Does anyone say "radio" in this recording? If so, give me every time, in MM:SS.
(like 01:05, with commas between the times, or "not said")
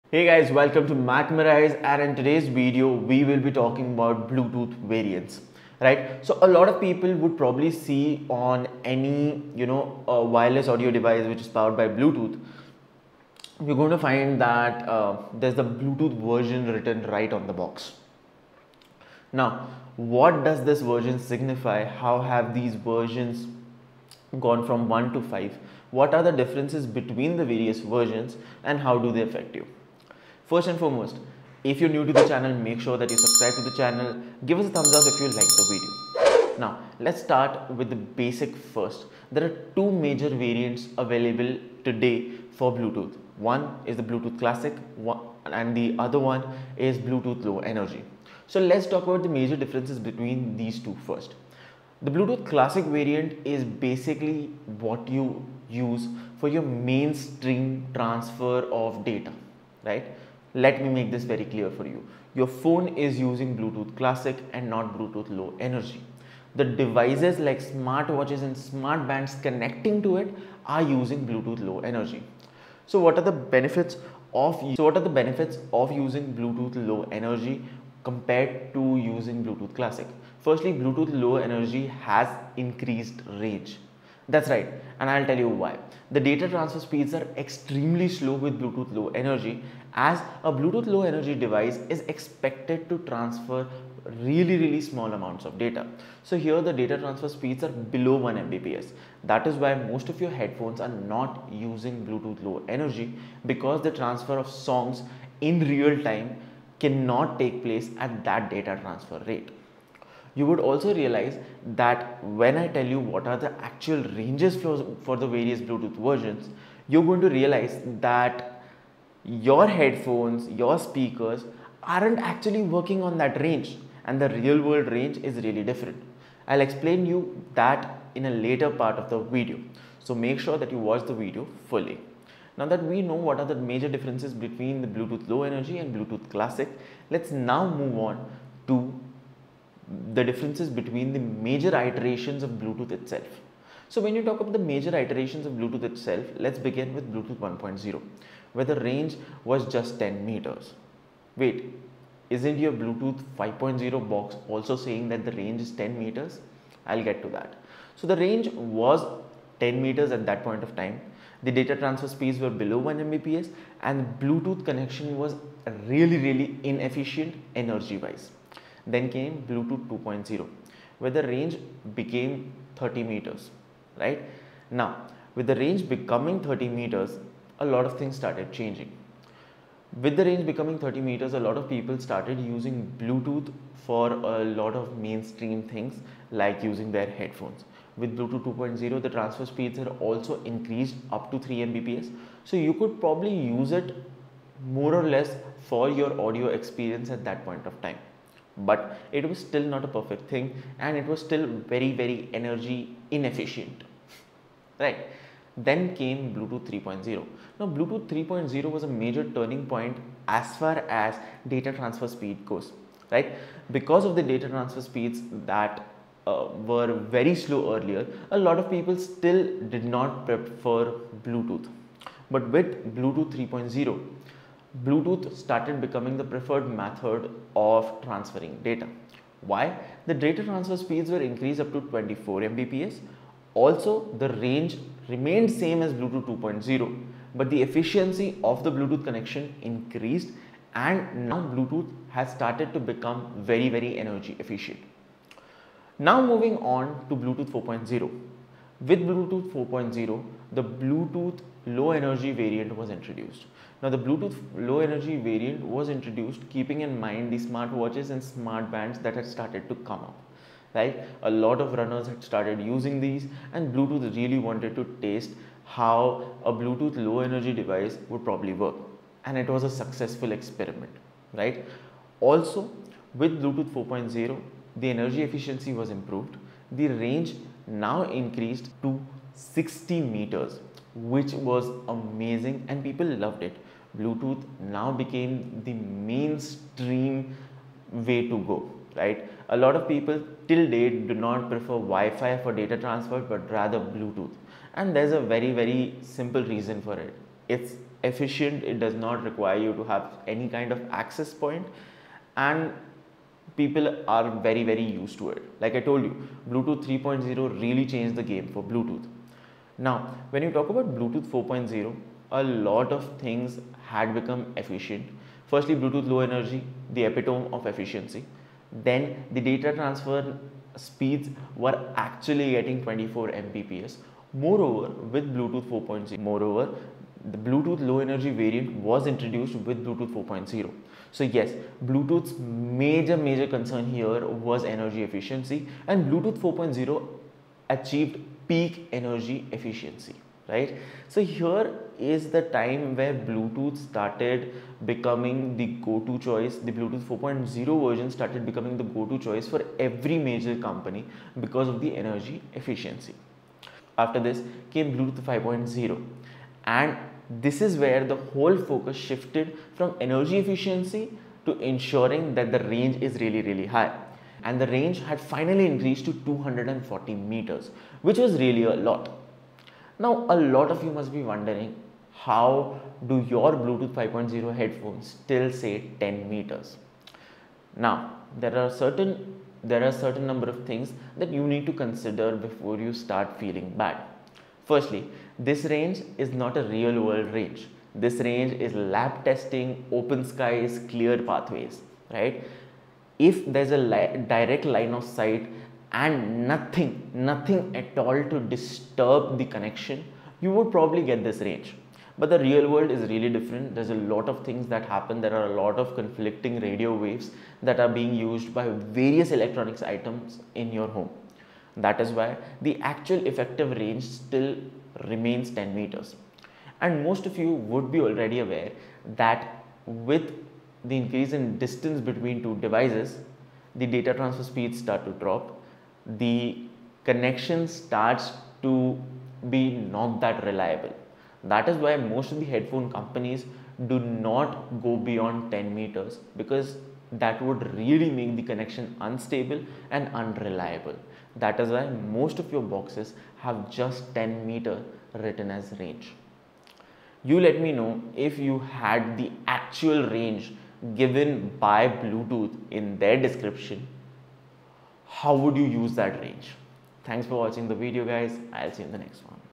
06:46.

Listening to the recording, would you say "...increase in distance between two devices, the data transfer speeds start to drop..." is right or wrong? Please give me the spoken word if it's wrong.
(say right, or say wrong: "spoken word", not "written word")
right.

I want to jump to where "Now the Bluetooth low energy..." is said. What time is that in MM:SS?
04:13.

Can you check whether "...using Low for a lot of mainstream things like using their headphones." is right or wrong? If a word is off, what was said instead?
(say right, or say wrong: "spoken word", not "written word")
wrong: "Bluetooth", not "Low".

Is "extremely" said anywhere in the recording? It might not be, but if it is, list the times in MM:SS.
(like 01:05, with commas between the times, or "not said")
01:27.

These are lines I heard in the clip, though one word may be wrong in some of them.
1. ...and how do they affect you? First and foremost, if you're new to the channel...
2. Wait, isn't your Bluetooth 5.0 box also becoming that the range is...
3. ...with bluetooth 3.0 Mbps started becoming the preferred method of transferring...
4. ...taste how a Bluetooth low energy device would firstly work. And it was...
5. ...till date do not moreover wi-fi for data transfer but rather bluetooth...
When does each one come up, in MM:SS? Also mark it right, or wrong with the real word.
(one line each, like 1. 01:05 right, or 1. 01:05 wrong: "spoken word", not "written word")
1. 00:28 right
2. 02:31 wrong: "saying", not "becoming"
3. 03:42 wrong: "Bluetooth", not "Mbps"
4. 04:25 wrong: "probably", not "firstly"
5. 04:50 wrong: "prefer", not "moreover".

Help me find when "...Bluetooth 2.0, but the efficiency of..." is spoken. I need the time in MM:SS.
03:55.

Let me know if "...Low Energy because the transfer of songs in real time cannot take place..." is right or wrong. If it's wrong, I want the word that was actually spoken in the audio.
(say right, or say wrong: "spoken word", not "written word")
right.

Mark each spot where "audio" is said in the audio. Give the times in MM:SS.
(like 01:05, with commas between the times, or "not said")
00:10, 03:16.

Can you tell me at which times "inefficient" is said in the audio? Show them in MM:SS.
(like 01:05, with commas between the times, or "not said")
02:46, 03:23.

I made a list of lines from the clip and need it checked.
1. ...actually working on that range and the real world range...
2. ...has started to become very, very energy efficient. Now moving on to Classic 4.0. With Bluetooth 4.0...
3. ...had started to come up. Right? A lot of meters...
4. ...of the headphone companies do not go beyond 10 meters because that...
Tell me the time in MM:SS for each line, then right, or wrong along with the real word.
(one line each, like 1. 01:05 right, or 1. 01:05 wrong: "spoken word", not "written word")
1. 02:02 right
2. 04:02 wrong: "Bluetooth", not "Classic"
3. 04:19 wrong: "runners", not "meters"
4. 07:12 right.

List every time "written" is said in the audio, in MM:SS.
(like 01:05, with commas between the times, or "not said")
00:16, 07:25.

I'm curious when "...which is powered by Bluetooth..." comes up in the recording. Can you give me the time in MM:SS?
00:11.